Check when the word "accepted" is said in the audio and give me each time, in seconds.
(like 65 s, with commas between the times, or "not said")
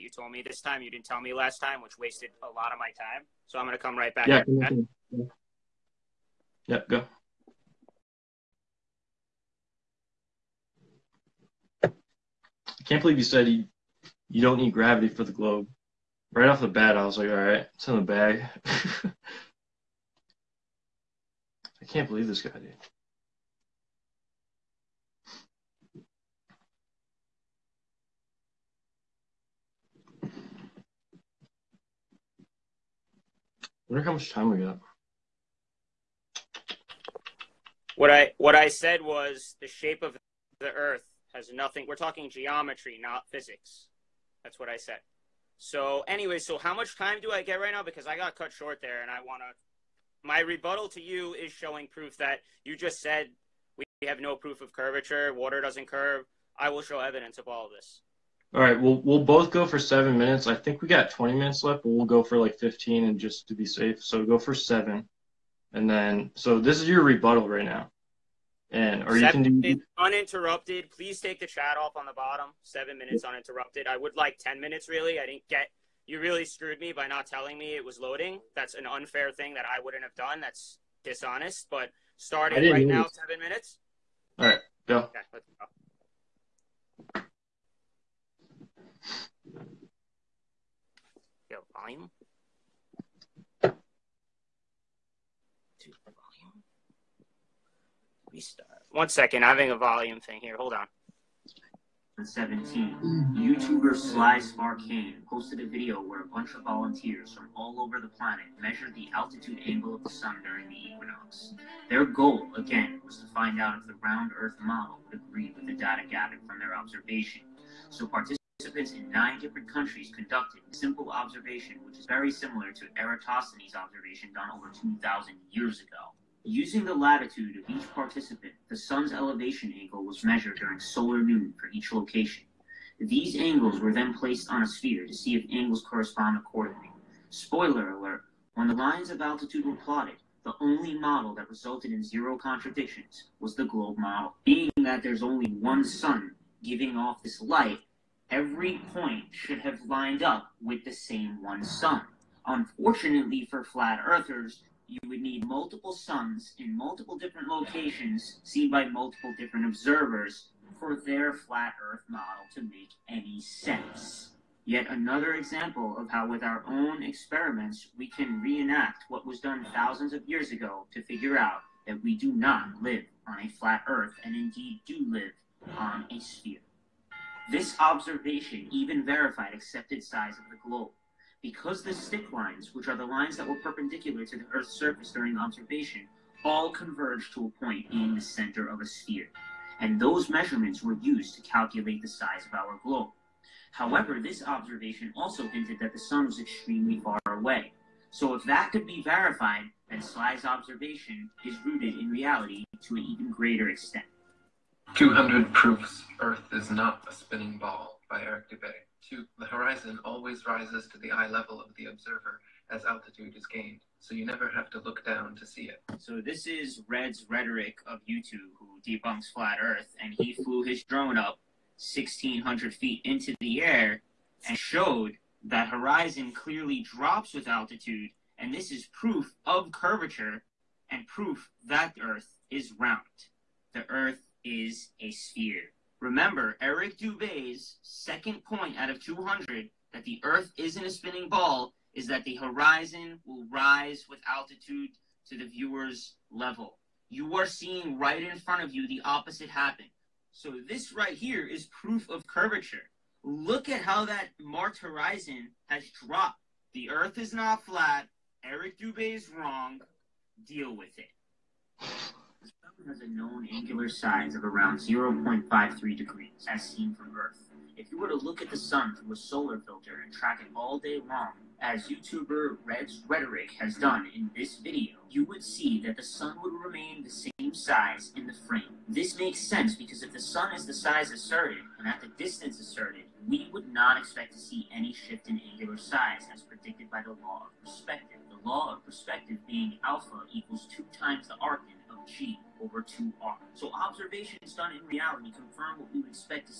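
179 s.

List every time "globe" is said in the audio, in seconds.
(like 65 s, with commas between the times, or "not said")
15 s, 143 s, 180 s, 192 s.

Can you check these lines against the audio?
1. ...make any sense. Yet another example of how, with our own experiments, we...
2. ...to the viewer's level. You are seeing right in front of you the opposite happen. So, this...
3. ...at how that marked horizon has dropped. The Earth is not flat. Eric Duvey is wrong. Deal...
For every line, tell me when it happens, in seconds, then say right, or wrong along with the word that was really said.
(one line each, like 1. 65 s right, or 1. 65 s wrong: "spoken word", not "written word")
1. 162 s right
2. 245 s right
3. 253 s right.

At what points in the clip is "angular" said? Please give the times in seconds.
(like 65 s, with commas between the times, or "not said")
263 s, 285 s.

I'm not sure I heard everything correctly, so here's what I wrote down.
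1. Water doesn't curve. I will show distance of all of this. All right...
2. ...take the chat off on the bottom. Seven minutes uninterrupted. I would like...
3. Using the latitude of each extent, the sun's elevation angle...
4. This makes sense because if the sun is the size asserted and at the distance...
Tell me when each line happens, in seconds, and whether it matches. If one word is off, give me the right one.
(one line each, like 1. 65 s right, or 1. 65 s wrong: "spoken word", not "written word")
1. 55 s wrong: "evidence", not "distance"
2. 71 s right
3. 126 s wrong: "participant", not "extent"
4. 278 s right.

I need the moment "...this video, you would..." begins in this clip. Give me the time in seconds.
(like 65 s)
274 s.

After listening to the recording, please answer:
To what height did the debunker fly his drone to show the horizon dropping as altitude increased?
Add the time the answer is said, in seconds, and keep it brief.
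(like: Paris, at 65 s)
1,600 feet, at 221 s.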